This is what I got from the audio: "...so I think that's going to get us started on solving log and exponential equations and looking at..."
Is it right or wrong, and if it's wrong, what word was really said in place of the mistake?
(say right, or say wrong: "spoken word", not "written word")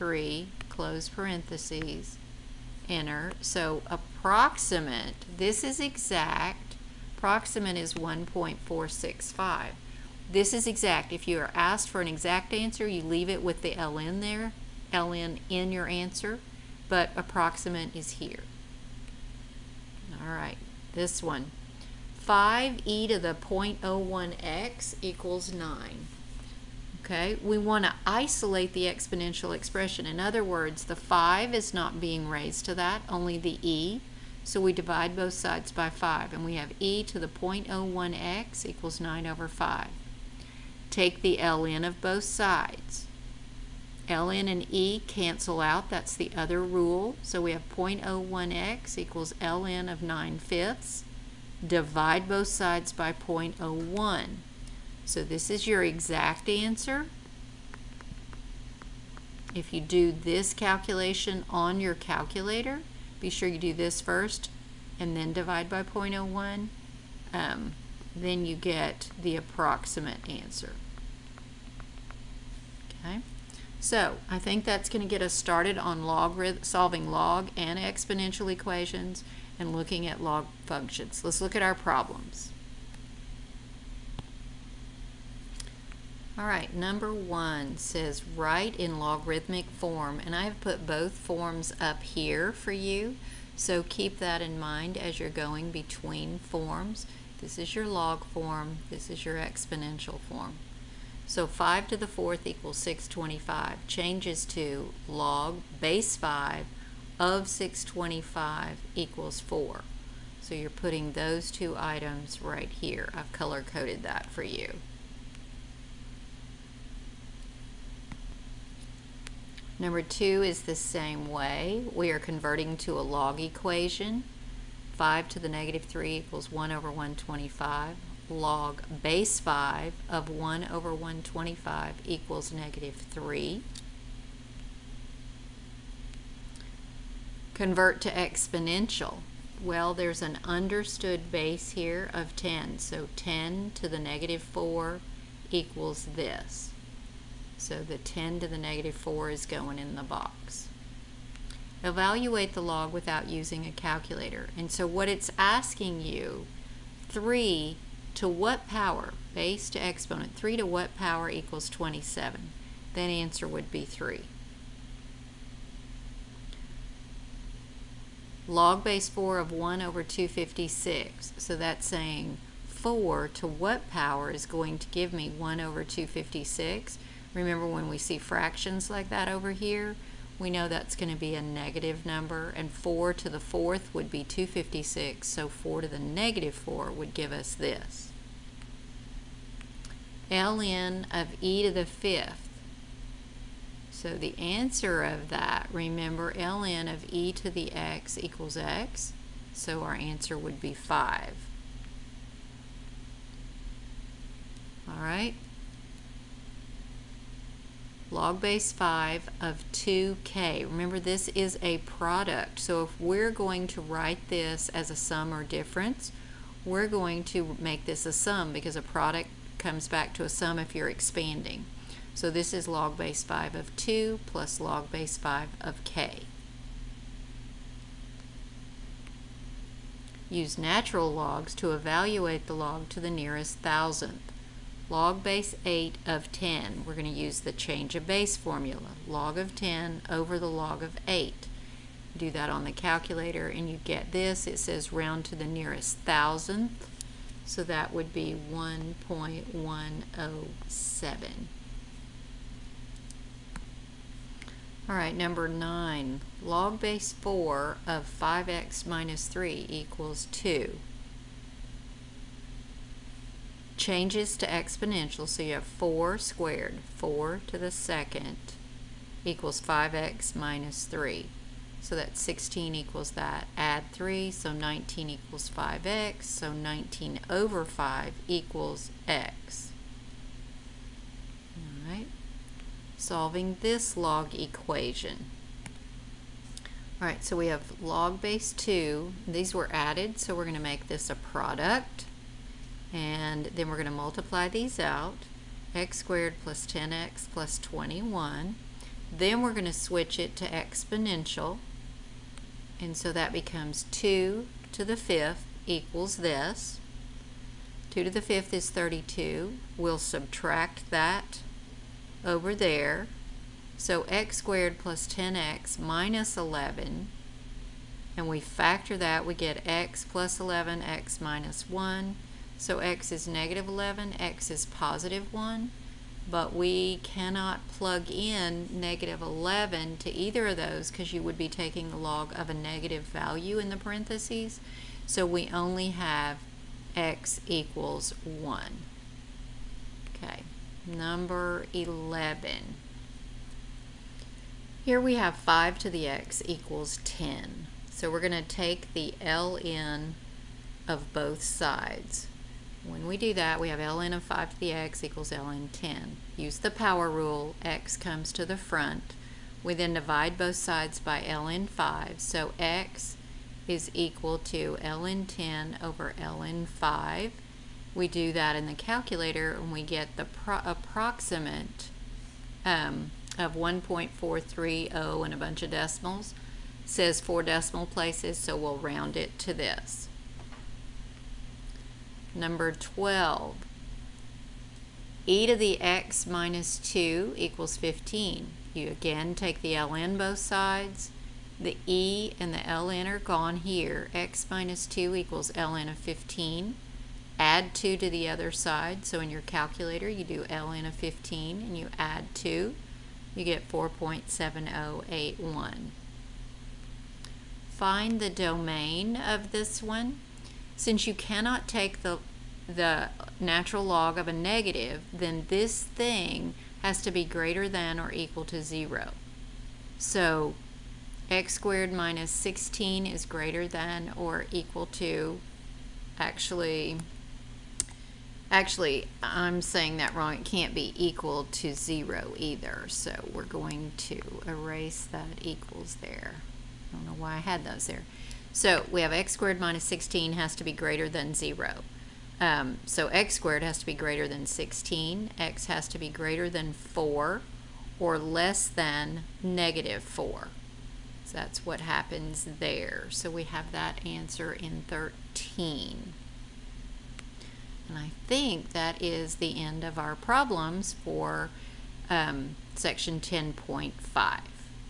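right.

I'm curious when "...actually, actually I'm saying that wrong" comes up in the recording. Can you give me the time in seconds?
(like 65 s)
426 s.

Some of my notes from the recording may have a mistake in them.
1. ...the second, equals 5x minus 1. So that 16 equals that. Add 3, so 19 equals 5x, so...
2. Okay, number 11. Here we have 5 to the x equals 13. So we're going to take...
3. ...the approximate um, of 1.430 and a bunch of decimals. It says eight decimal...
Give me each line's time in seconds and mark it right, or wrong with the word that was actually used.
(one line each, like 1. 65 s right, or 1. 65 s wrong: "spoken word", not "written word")
1. 267 s wrong: "3", not "1"
2. 340 s wrong: "10", not "13"
3. 370 s wrong: "four", not "eight".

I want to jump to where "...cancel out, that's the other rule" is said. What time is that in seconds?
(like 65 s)
45 s.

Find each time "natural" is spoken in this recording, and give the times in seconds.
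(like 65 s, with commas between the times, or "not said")
230 s, 413 s.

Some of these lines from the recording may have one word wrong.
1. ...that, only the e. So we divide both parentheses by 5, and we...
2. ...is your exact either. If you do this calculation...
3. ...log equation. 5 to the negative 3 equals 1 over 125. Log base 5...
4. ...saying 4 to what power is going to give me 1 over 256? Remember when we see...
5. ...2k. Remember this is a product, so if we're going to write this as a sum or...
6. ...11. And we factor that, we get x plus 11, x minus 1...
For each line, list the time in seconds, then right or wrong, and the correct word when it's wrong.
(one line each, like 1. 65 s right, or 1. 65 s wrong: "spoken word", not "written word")
1. 32 s wrong: "sides", not "parentheses"
2. 55 s wrong: "answer", not "either"
3. 123 s right
4. 171 s right
5. 209 s right
6. 316 s right.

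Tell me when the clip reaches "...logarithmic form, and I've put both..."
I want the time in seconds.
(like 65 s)
89 s.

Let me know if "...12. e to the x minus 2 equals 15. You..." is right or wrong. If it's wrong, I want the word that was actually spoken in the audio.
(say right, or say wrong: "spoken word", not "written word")
right.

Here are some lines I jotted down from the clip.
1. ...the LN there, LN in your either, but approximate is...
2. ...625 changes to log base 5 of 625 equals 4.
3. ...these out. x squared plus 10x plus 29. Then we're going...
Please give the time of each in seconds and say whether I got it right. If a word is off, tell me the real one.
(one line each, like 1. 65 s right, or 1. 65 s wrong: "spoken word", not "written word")
1. 13 s wrong: "answer", not "either"
2. 102 s right
3. 294 s wrong: "21", not "29".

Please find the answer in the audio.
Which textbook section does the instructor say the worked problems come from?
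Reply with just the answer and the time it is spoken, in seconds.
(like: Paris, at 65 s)
10.5, at 463 s.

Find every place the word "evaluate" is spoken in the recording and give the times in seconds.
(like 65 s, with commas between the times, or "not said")
151 s, 231 s.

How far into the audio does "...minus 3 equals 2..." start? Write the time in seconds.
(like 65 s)
258 s.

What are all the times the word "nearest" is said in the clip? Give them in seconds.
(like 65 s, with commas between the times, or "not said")
233 s, 245 s.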